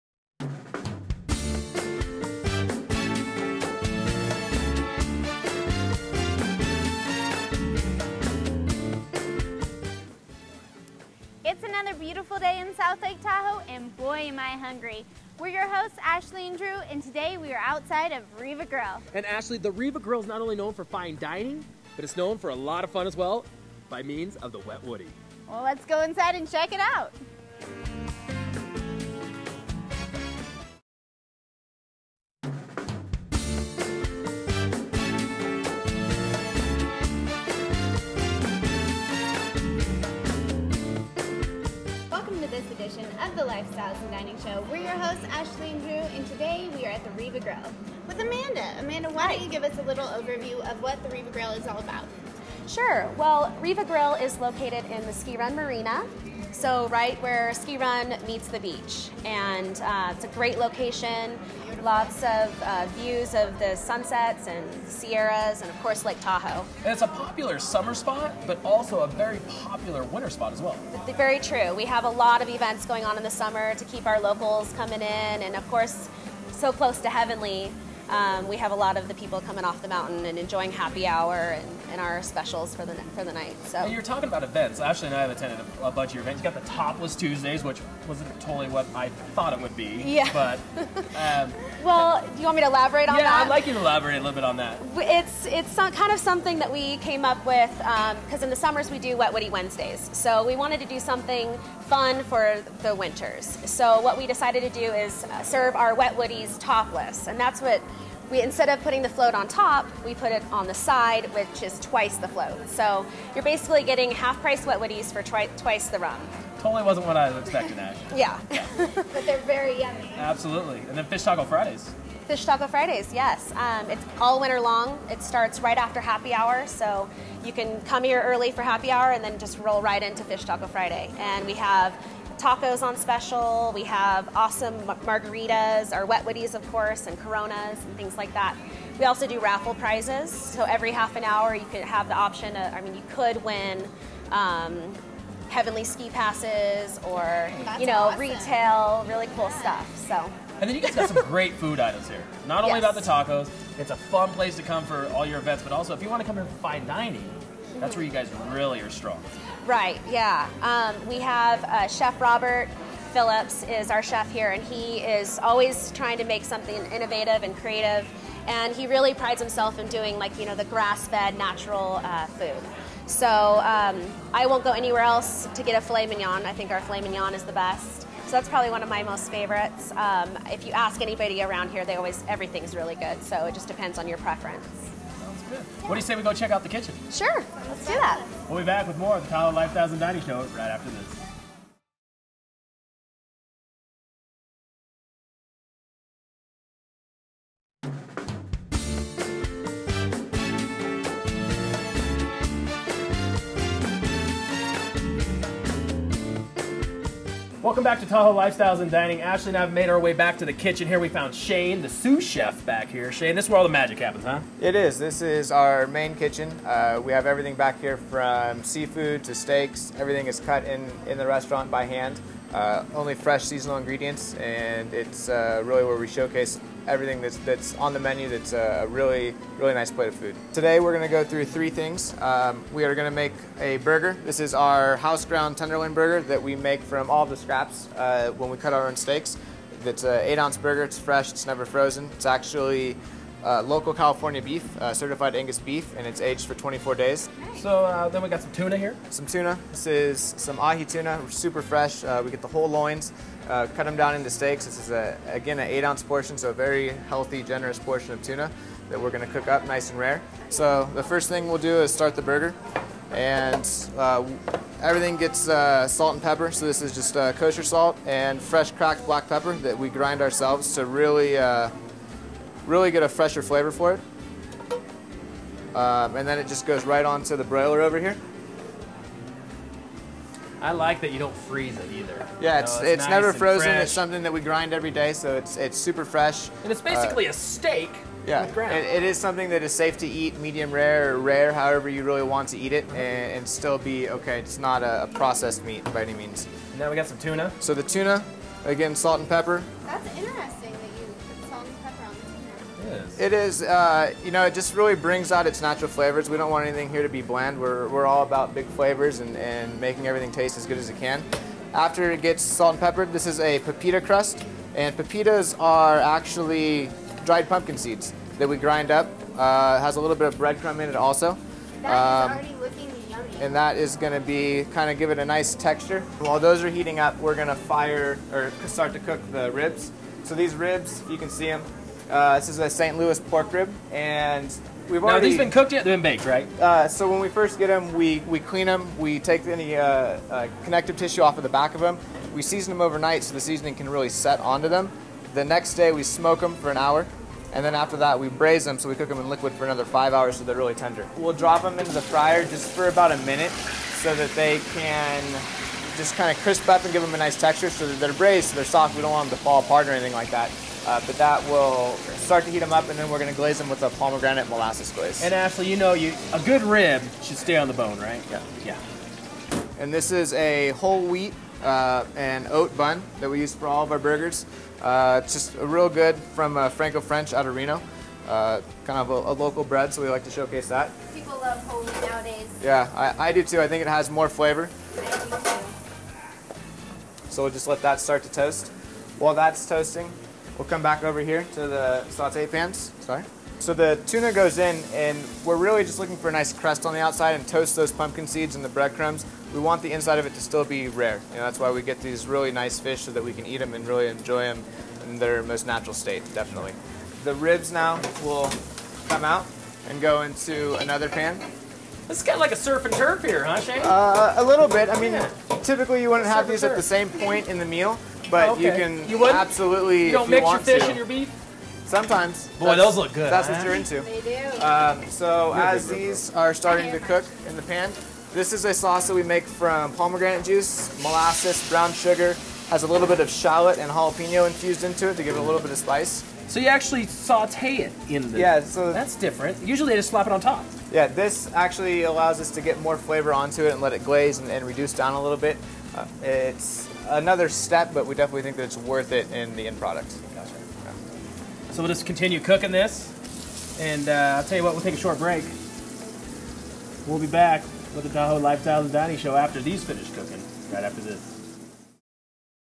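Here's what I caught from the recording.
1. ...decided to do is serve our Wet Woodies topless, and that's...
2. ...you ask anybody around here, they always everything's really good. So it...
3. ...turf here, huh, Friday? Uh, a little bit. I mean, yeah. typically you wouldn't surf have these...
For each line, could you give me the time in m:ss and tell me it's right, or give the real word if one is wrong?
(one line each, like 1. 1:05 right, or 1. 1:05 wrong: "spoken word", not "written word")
1. 1:44 right
2. 3:00 right
3. 6:52 wrong: "Shane", not "Friday".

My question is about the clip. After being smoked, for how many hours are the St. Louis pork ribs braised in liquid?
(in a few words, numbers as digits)
5.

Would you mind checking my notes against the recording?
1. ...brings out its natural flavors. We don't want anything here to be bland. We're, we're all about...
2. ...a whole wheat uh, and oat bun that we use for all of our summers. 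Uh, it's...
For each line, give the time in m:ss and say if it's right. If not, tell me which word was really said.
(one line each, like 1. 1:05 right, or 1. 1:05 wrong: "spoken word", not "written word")
1. 5:04 right
2. 6:10 wrong: "burgers", not "summers".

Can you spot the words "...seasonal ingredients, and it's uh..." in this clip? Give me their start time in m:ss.
3:43.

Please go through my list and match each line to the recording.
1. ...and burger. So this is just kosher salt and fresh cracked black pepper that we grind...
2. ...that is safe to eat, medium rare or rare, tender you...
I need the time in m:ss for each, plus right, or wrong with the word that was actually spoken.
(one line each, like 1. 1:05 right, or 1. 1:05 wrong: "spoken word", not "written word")
1. 4:26 wrong: "pepper", not "burger"
2. 4:49 wrong: "however", not "tender".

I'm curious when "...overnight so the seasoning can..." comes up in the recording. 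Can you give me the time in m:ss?
5:42.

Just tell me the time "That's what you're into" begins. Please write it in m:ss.
7:03.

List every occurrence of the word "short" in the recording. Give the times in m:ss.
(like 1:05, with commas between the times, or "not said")
7:34.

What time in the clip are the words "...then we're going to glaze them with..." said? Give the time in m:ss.
6:02.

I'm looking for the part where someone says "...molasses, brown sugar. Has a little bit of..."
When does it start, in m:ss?
7:11.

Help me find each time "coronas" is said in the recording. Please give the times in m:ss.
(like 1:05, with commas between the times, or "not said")
2:17.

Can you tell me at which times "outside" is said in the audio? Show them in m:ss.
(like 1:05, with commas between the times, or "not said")
0:17, 6:36.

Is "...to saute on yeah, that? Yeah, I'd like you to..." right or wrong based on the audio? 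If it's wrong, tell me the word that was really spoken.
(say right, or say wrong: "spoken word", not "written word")
wrong: "elaborate", not "saute".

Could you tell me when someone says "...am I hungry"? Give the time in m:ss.
0:14.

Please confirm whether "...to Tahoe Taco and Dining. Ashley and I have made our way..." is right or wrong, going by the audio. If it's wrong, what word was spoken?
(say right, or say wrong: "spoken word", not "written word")
wrong: "Lifestyles", not "Taco".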